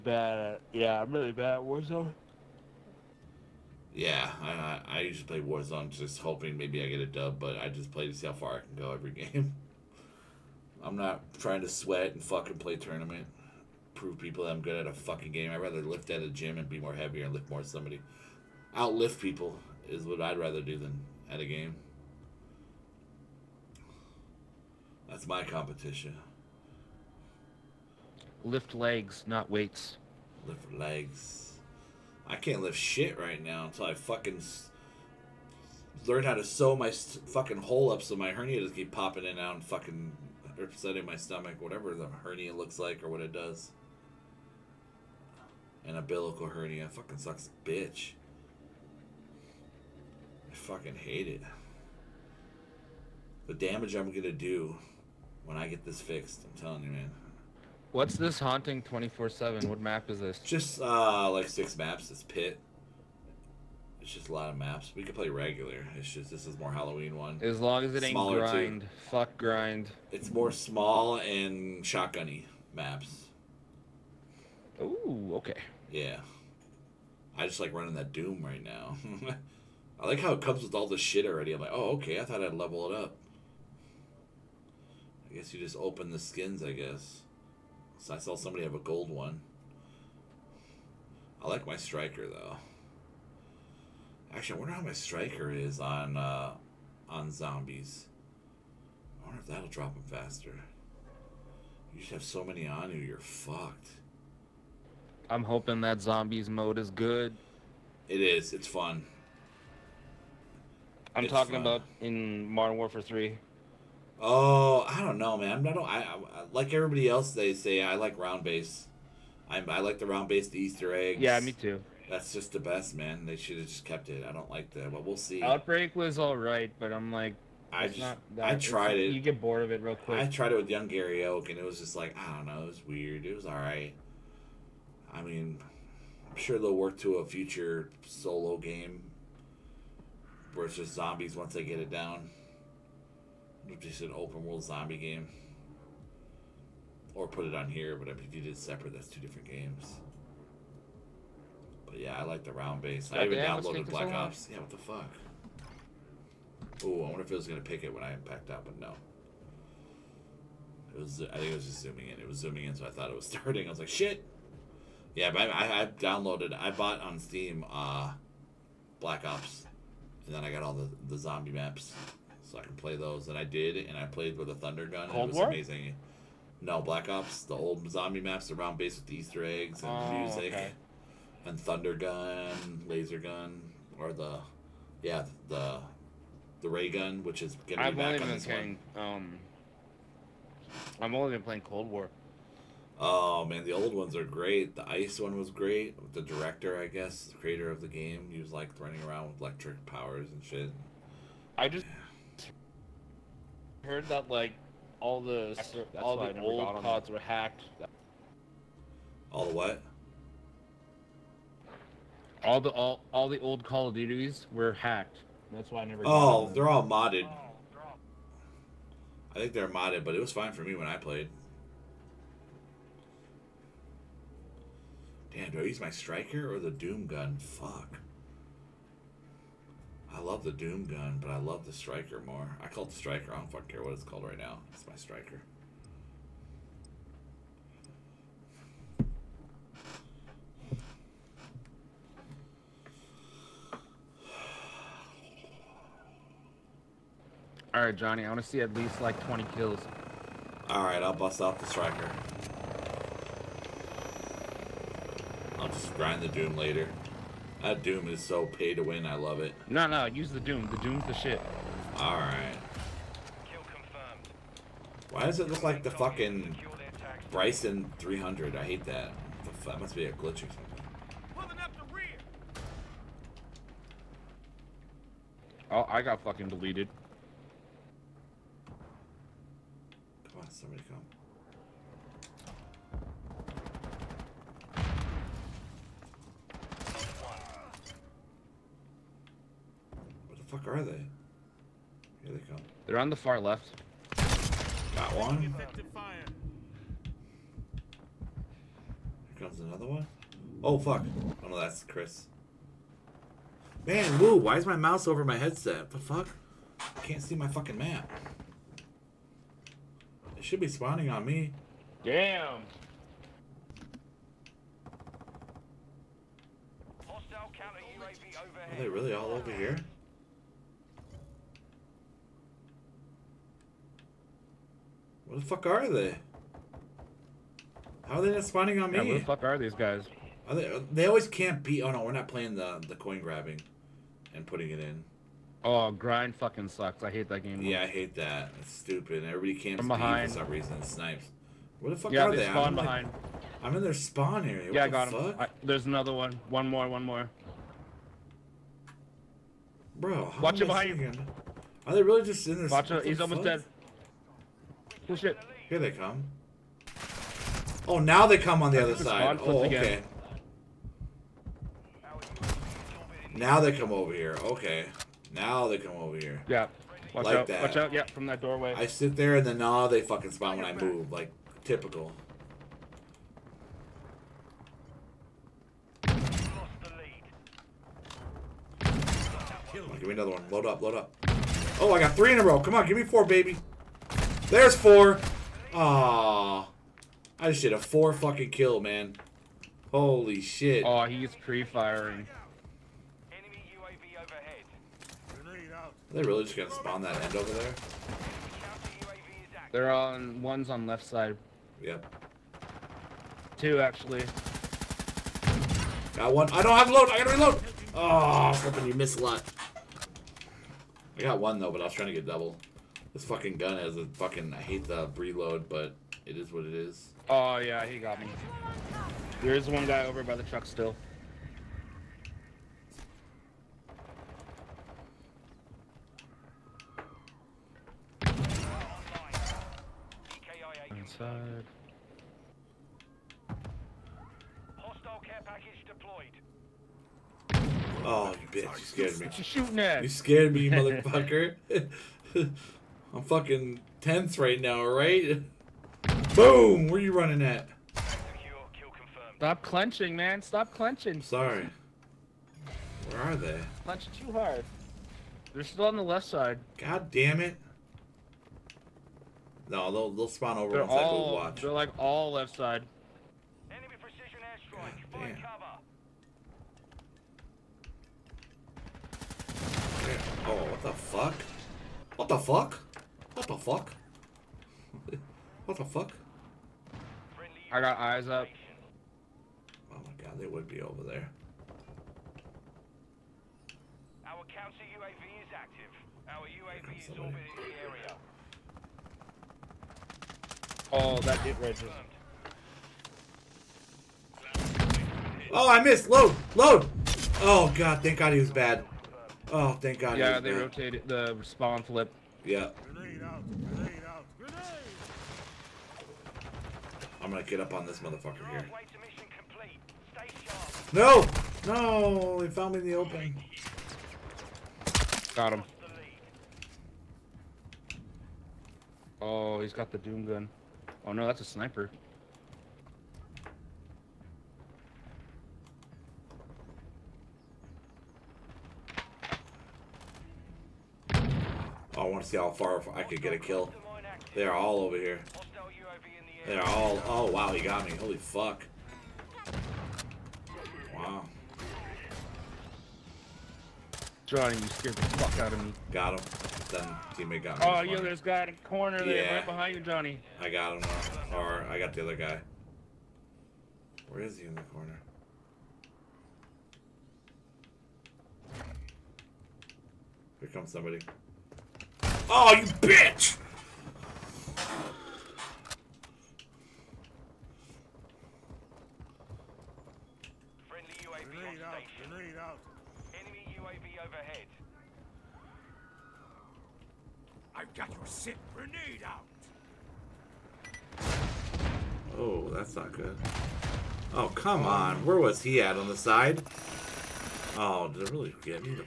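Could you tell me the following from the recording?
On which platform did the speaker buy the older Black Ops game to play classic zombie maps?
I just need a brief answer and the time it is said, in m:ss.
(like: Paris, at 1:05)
Steam, at 2:47.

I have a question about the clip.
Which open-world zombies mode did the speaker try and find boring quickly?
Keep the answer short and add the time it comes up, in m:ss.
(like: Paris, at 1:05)
Outbreak, at 2:05.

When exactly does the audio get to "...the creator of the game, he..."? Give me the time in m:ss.
3:17.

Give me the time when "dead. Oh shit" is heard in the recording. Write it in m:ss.
5:53.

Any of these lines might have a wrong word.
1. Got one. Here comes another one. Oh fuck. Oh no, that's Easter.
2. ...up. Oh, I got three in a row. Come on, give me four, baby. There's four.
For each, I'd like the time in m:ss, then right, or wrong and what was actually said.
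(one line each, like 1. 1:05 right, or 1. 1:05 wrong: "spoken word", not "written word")
1. 4:54 wrong: "Chris", not "Easter"
2. 6:20 right.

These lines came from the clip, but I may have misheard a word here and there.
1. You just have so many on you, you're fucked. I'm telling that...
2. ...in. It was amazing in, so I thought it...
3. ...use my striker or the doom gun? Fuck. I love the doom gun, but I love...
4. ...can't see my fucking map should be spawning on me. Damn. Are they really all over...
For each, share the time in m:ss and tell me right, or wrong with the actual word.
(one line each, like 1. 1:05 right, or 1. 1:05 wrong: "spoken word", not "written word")
1. 1:41 wrong: "hoping", not "telling"
2. 2:42 wrong: "zooming", not "amazing"
3. 3:45 right
4. 5:07 right.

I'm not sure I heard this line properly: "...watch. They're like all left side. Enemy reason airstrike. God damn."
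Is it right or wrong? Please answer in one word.
wrong.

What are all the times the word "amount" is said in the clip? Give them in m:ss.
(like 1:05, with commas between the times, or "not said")
not said.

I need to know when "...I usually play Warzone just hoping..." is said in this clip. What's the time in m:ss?
0:04.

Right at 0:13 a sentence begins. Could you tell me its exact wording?
Prove people that I'm good at a fucking game.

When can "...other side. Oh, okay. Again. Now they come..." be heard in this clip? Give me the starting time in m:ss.
5:58.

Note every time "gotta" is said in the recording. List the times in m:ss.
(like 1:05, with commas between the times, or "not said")
6:47.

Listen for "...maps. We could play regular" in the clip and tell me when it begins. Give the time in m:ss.
1:04.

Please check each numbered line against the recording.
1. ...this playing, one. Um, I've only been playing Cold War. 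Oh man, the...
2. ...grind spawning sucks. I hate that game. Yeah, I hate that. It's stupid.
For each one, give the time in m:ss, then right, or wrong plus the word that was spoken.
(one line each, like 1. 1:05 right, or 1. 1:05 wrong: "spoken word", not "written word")
1. 3:08 right
2. 5:35 wrong: "fucking", not "spawning".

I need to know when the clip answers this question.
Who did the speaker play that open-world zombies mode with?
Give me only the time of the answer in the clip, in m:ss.
2:10.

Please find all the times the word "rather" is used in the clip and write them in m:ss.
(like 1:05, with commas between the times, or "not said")
0:15, 0:20.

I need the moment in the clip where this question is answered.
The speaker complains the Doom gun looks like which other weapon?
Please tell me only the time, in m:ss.
4:27.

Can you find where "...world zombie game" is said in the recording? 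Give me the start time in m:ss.
2:24.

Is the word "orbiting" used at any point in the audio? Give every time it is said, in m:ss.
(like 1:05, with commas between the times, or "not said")
8:07.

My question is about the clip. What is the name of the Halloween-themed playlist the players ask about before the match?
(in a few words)
Haunting 24/7.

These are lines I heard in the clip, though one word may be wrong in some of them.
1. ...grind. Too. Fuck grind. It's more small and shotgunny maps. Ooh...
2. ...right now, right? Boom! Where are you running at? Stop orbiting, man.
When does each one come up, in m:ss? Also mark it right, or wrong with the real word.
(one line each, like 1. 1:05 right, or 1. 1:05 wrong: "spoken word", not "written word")
1. 1:08 right
2. 7:24 wrong: "clenching", not "orbiting".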